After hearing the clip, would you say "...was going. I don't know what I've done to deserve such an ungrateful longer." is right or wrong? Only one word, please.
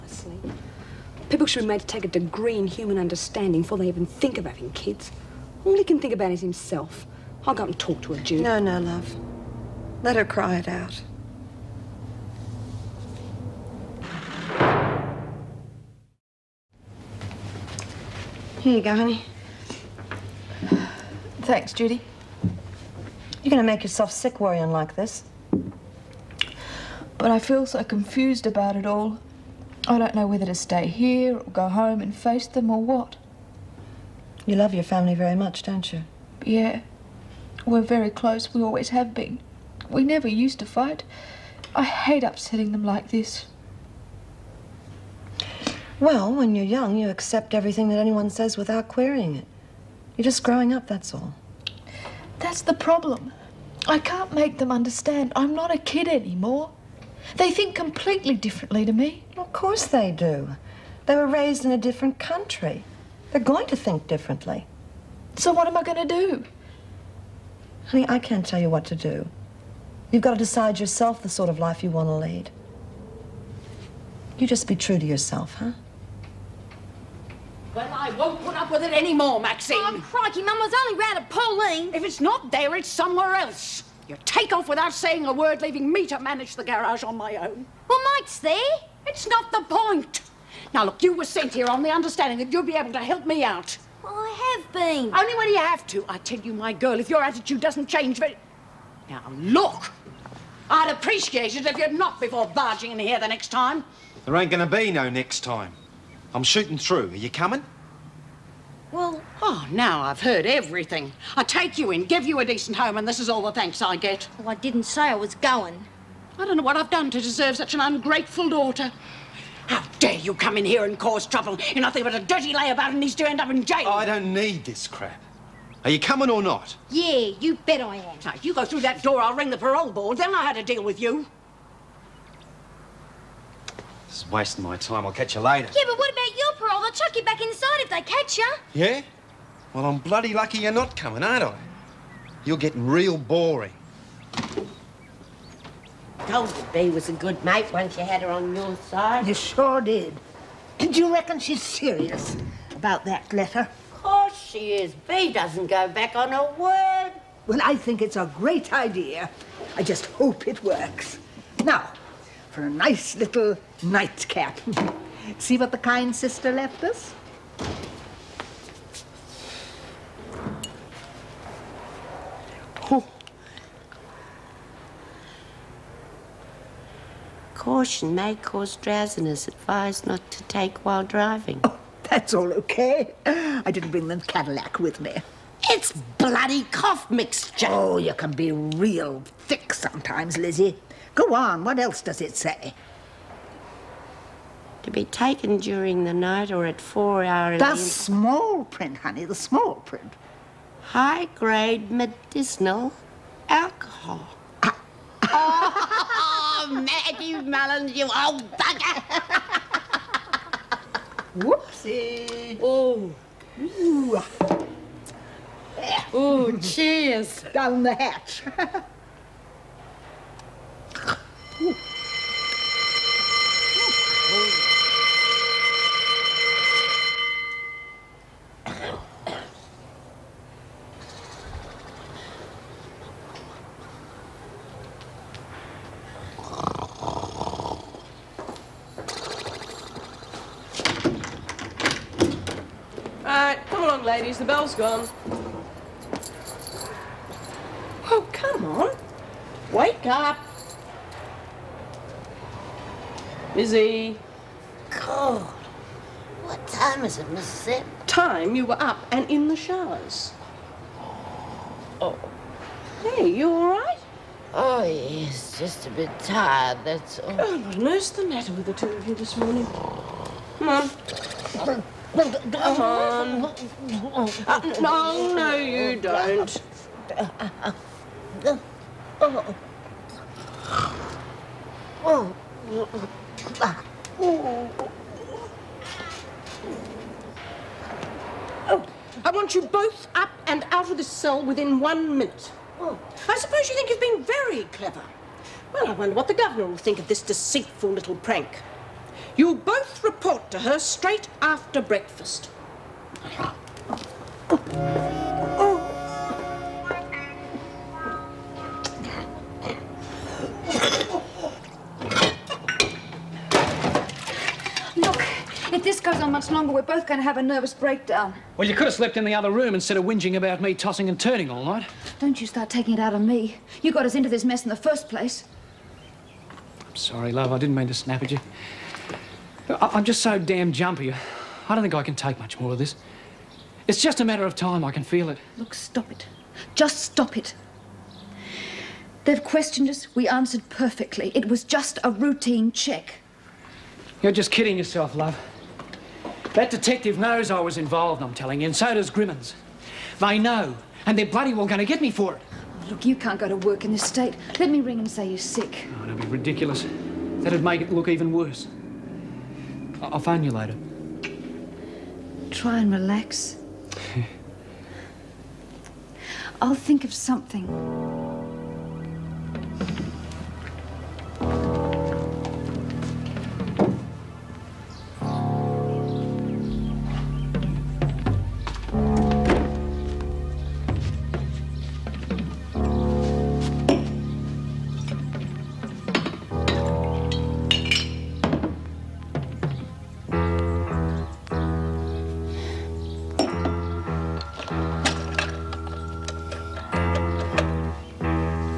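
wrong.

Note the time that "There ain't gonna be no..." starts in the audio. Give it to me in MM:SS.
01:44.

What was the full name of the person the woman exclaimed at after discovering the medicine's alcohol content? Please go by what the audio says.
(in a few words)
Maggie Mullins.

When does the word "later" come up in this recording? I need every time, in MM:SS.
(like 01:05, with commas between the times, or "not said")
02:15, 06:00.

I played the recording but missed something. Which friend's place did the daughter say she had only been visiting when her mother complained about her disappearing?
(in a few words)
Pauline.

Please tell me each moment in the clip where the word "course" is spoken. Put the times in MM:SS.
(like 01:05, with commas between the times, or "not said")
00:59, 02:34.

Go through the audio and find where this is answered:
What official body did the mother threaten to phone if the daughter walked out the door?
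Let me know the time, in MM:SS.
02:09.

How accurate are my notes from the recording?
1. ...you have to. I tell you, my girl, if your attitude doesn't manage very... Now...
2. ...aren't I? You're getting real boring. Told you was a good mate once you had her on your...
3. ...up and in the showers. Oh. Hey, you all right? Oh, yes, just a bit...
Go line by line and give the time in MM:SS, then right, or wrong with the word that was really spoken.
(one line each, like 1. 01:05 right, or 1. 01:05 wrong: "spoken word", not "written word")
1. 01:35 wrong: "change", not "manage"
2. 02:21 right
3. 04:18 right.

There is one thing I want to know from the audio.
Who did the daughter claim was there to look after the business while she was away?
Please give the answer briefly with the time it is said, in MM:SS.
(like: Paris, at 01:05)
Mike, at 01:28.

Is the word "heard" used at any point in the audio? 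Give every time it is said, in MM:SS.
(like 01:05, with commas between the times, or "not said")
01:50.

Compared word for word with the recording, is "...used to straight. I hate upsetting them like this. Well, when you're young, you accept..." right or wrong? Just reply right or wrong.
wrong.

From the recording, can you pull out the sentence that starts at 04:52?
I suppose you think you've been very clever.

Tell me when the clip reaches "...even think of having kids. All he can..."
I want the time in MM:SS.
00:03.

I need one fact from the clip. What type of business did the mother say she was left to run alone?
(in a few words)
Garage.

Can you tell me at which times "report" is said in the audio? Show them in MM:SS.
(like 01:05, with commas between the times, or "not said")
05:00.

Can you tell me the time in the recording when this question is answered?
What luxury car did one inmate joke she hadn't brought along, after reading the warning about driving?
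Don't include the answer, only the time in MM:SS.
03:04.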